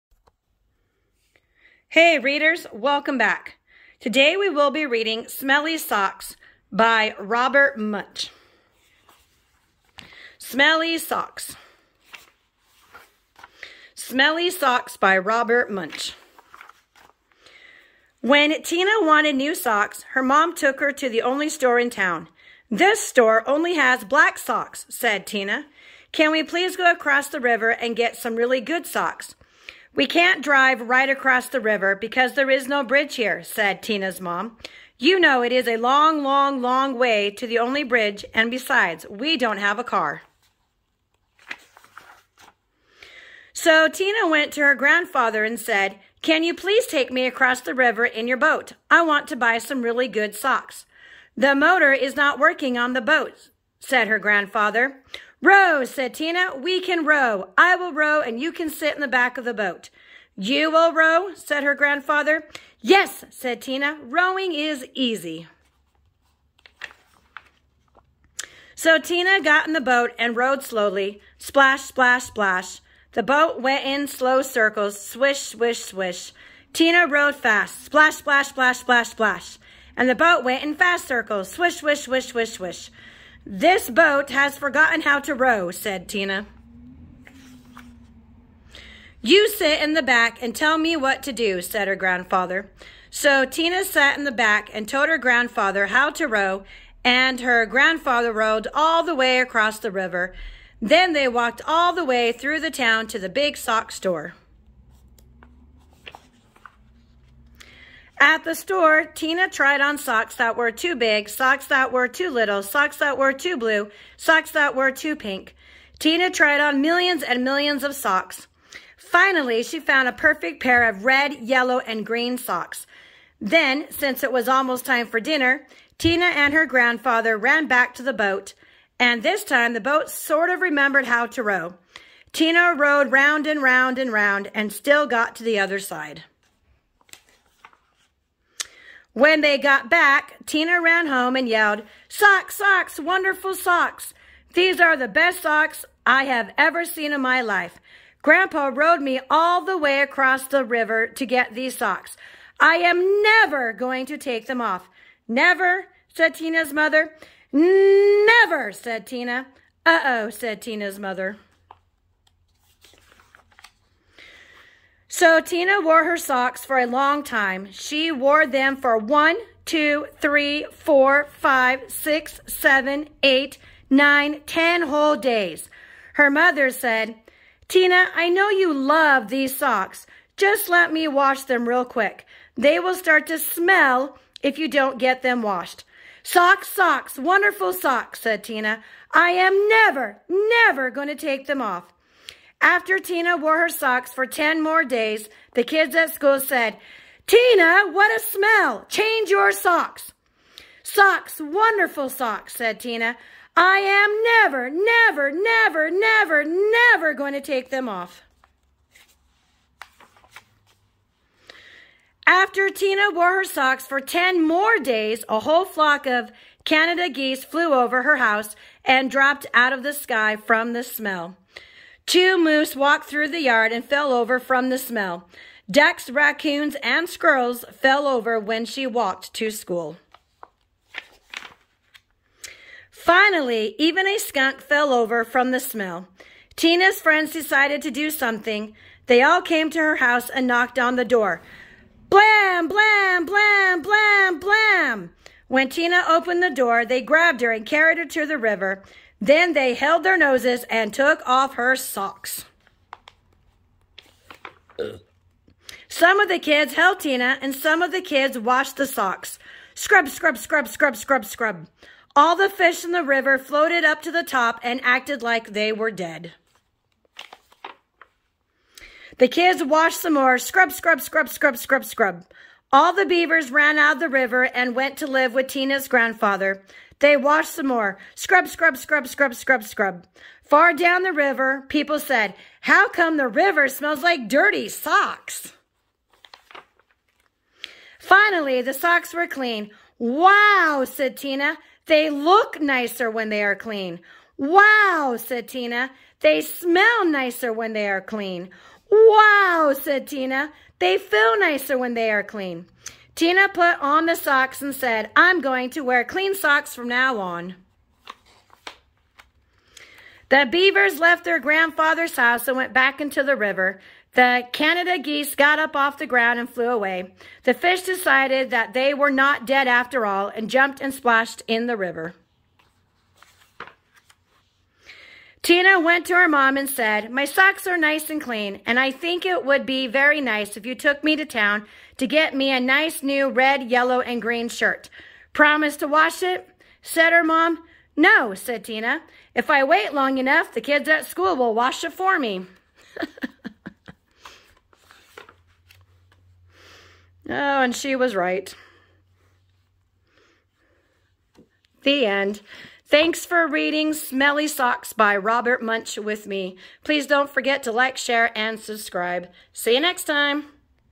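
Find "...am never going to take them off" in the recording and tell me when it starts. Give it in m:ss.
2:32.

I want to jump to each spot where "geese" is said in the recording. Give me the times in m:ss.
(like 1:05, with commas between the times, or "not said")
3:37, 5:14.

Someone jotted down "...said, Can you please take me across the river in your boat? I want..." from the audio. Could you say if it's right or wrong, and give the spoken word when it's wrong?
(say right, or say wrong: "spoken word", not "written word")
right.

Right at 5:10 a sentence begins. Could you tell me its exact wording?
The beavers left their grandfather's house and went back into the river.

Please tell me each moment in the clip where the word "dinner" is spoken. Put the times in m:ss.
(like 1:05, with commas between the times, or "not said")
2:05.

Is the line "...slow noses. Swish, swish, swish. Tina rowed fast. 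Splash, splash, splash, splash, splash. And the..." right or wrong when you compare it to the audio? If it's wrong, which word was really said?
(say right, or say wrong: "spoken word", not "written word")
wrong: "circles", not "noses".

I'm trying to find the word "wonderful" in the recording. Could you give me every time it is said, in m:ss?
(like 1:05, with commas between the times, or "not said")
2:22, 3:07, 3:21.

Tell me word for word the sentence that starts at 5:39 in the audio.
If I wait long enough, the kids at school will wash it for me.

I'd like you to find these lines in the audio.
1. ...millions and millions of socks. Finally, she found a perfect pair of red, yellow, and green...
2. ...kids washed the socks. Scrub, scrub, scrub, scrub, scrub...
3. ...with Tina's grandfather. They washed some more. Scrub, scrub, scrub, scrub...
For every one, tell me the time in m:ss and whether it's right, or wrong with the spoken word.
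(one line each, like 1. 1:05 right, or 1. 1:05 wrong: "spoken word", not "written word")
1. 1:56 right
2. 4:18 right
3. 4:35 right.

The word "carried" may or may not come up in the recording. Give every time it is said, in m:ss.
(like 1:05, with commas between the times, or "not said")
4:07.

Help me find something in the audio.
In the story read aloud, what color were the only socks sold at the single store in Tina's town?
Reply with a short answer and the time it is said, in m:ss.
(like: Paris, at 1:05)
black, at 0:24.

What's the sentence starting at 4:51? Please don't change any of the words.
They look nicer when they are clean.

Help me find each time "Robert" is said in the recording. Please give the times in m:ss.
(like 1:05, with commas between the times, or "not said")
0:07, 0:15, 5:55.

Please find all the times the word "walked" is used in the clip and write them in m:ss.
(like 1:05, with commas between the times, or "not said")
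1:41, 3:42, 3:48.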